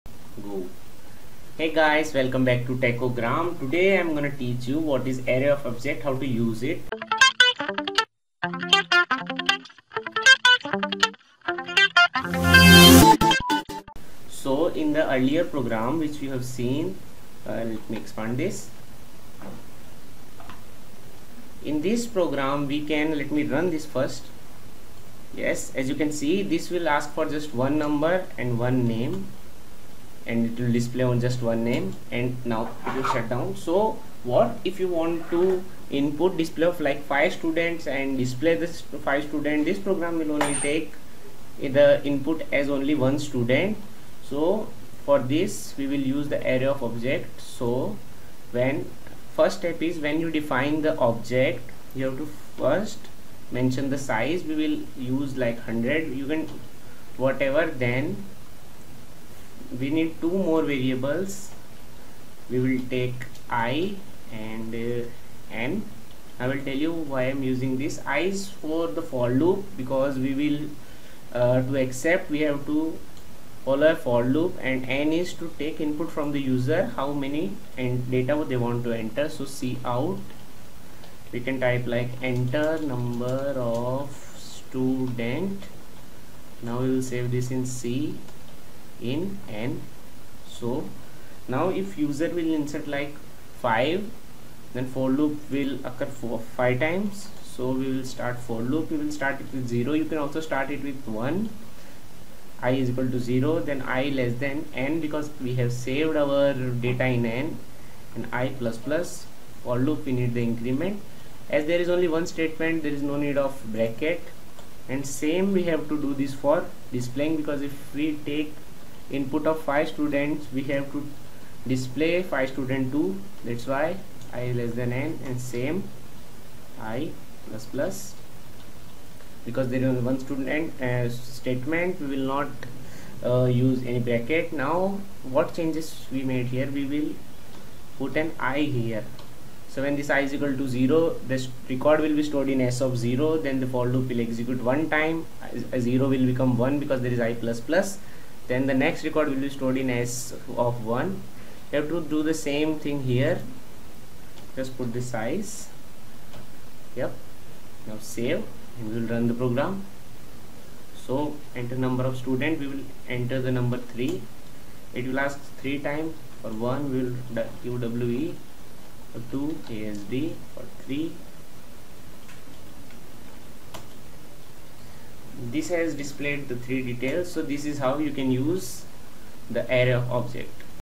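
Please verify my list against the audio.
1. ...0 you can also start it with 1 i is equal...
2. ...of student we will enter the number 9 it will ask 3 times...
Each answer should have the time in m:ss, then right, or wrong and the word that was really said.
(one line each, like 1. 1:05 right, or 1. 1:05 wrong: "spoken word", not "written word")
1. 1:39 right
2. 2:42 wrong: "3", not "9".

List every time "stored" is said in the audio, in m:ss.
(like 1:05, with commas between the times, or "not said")
2:22, 2:29.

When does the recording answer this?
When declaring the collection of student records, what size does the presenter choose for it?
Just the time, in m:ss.
0:55.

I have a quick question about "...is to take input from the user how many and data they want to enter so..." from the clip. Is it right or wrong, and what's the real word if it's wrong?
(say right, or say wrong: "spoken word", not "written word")
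right.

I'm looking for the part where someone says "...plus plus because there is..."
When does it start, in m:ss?
2:07.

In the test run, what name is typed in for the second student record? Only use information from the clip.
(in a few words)
asd.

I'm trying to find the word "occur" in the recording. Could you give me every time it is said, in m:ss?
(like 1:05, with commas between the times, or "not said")
1:35.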